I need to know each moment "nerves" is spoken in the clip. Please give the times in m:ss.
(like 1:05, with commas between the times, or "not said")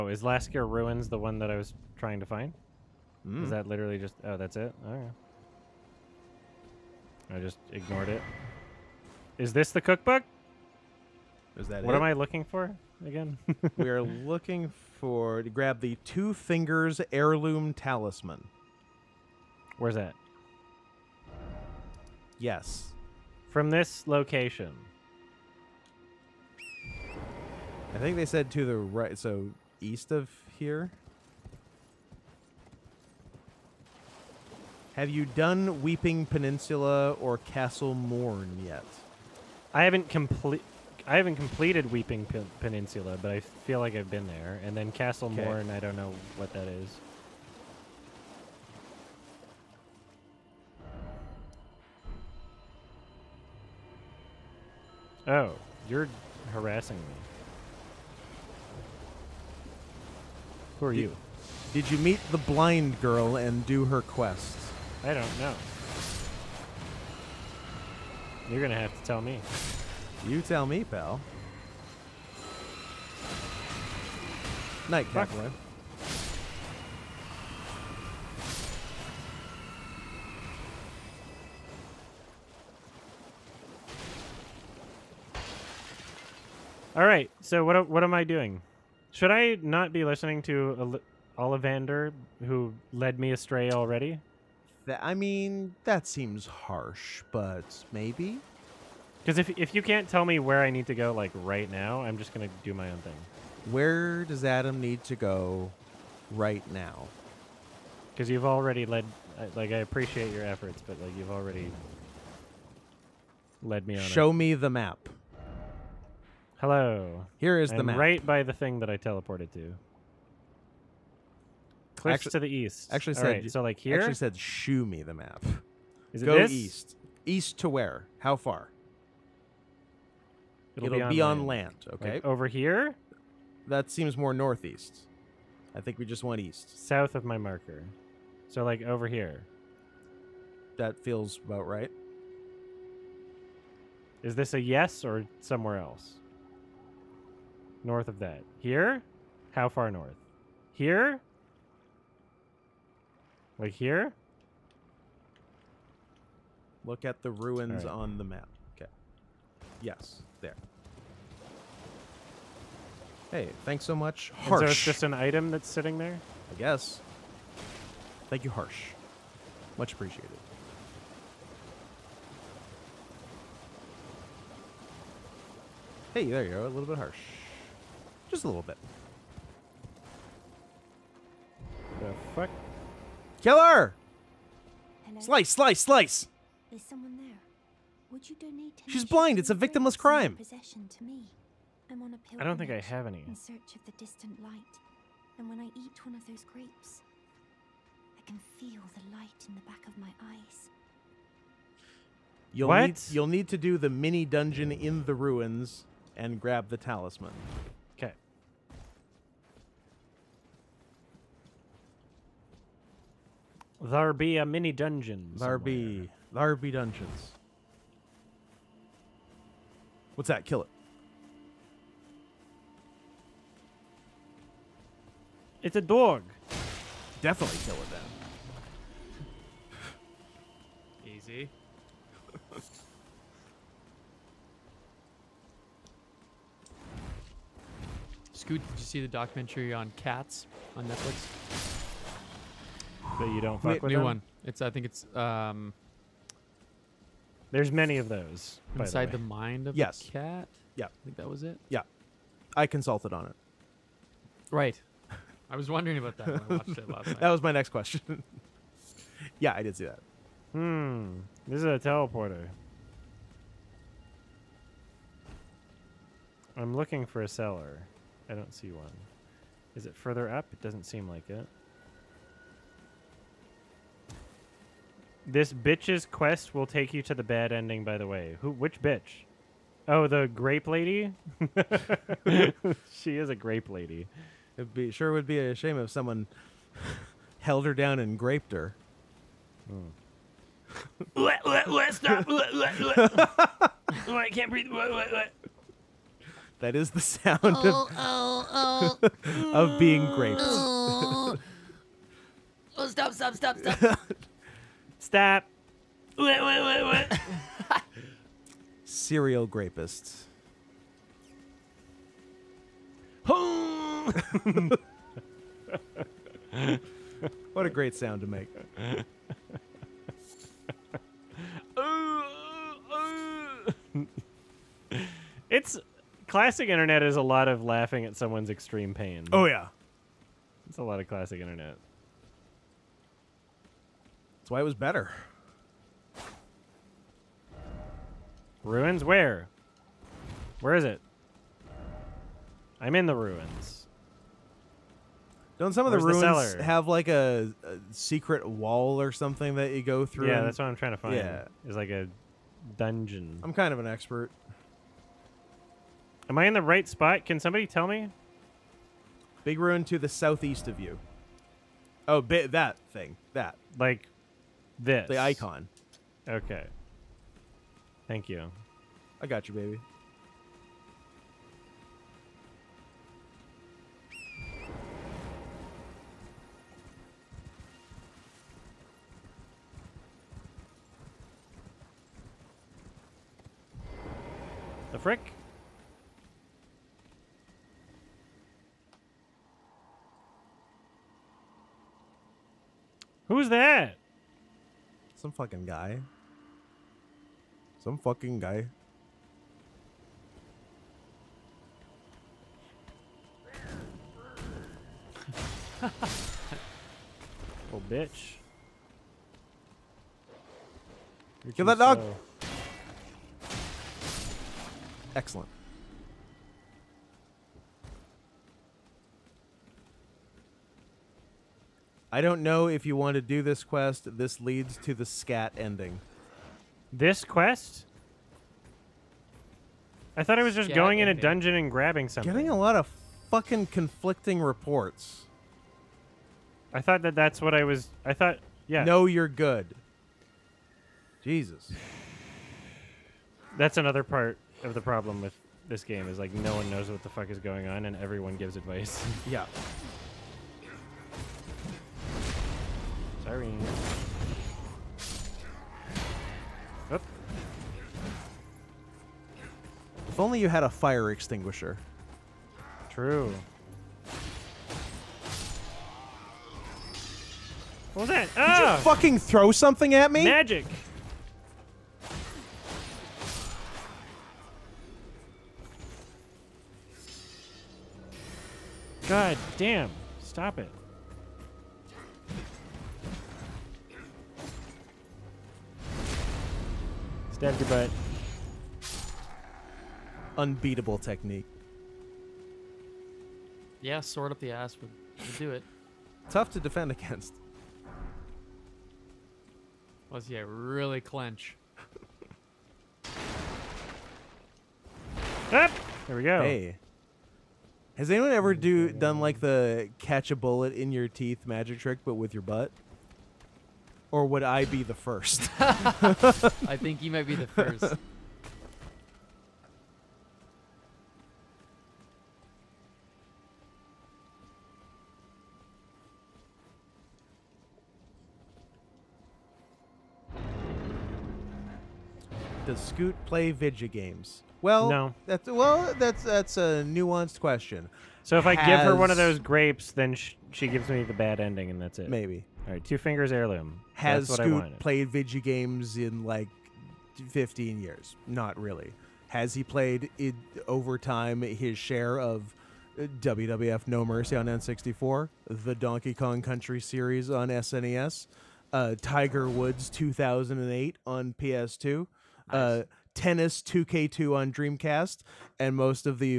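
not said.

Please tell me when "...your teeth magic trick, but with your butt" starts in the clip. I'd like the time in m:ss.
8:30.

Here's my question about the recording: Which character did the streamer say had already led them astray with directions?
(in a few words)
Ollivander.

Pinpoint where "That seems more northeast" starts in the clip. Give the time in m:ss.
2:13.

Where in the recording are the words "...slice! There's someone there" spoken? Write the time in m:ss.
3:05.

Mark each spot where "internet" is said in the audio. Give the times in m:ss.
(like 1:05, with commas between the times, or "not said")
5:26, 5:31.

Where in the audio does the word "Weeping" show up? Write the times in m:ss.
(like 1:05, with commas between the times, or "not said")
0:35, 0:41.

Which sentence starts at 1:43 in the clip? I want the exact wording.
Where does Adam need to go right now?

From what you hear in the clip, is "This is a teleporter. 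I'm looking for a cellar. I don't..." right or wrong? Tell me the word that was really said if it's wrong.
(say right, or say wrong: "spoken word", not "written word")
right.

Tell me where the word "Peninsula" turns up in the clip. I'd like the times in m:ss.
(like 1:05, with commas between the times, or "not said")
0:36, 0:42.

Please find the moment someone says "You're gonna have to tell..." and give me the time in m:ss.
1:08.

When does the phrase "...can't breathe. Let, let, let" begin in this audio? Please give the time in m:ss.
4:54.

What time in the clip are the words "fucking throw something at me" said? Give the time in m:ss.
7:48.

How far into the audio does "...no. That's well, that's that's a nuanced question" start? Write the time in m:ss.
8:54.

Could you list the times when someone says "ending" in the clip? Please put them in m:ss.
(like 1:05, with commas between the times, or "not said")
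4:37, 7:05, 7:11, 9:01.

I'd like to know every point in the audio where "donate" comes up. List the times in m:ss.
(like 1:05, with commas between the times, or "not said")
3:08.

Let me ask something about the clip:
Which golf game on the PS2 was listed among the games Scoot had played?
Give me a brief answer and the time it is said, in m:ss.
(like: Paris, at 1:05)
Tiger Woods 2008, at 9:19.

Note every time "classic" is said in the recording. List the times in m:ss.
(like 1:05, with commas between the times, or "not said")
5:26, 5:31.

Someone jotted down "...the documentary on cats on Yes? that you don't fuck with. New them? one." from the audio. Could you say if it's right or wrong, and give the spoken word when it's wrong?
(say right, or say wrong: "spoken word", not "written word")
wrong: "Netflix", not "Yes".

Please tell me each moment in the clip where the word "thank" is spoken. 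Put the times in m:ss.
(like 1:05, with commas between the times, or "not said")
2:43, 2:48, 6:08.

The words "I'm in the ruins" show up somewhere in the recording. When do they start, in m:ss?
5:42.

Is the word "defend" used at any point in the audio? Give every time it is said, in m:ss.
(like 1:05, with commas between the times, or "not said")
8:16.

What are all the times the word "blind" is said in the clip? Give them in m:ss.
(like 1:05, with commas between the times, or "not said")
1:02, 3:09.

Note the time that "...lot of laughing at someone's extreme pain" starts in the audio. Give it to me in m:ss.
5:27.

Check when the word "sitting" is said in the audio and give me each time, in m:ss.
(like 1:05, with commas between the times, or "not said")
2:45.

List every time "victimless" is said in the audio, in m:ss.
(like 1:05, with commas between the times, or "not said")
3:09.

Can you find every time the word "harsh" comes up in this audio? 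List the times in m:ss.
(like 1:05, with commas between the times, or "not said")
1:36, 2:44, 2:48, 2:56.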